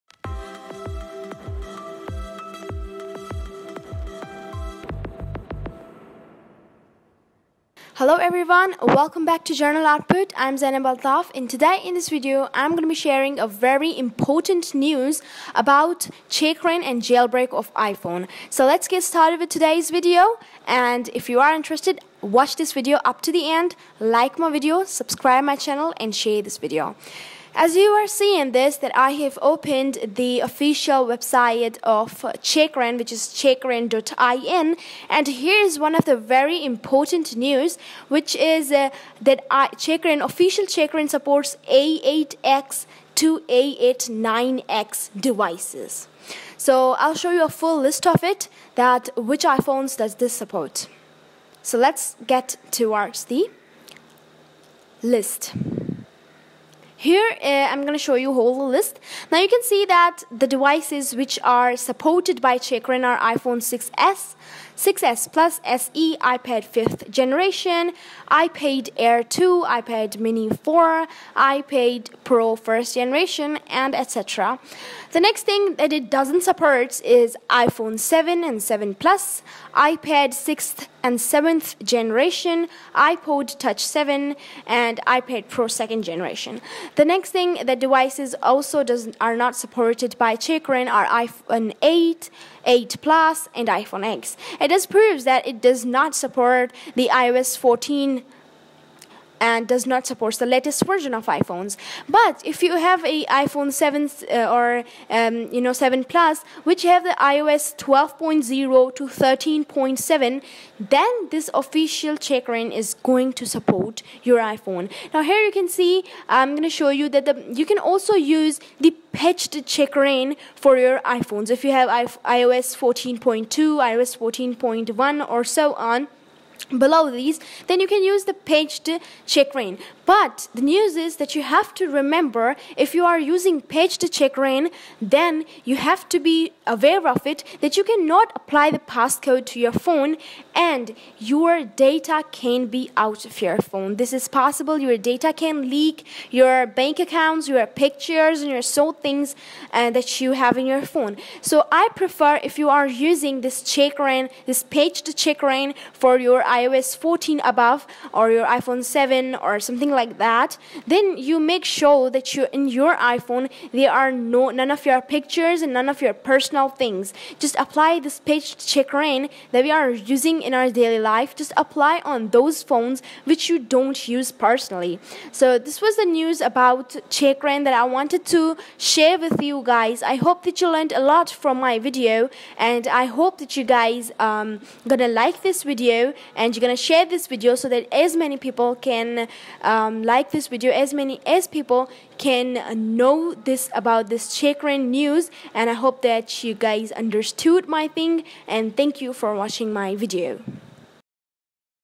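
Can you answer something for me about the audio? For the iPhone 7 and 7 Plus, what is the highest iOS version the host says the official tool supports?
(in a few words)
13.7.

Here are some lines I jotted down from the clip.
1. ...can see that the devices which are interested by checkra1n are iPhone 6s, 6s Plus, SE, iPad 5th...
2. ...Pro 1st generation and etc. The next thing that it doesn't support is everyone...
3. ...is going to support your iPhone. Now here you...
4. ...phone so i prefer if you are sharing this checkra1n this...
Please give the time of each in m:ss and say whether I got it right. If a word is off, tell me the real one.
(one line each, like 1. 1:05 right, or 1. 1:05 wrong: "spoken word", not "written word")
1. 0:59 wrong: "supported", not "interested"
2. 1:12 wrong: "iPhone", not "everyone"
3. 1:52 right
4. 2:30 wrong: "using", not "sharing".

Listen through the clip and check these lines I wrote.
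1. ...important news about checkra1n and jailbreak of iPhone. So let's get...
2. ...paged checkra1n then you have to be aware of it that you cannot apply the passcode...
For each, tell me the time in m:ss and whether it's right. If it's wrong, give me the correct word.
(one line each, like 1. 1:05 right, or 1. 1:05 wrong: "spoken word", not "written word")
1. 0:13 right
2. 2:13 right.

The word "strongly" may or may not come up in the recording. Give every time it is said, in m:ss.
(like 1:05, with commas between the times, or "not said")
not said.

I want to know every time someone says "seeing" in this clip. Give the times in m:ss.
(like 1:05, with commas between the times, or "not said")
0:28.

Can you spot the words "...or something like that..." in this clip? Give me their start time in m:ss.
2:39.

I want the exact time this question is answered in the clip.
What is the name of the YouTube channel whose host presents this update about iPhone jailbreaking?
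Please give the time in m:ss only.
0:09.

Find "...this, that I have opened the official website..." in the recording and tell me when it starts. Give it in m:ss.
0:28.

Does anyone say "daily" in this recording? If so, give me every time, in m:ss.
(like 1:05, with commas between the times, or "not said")
2:50.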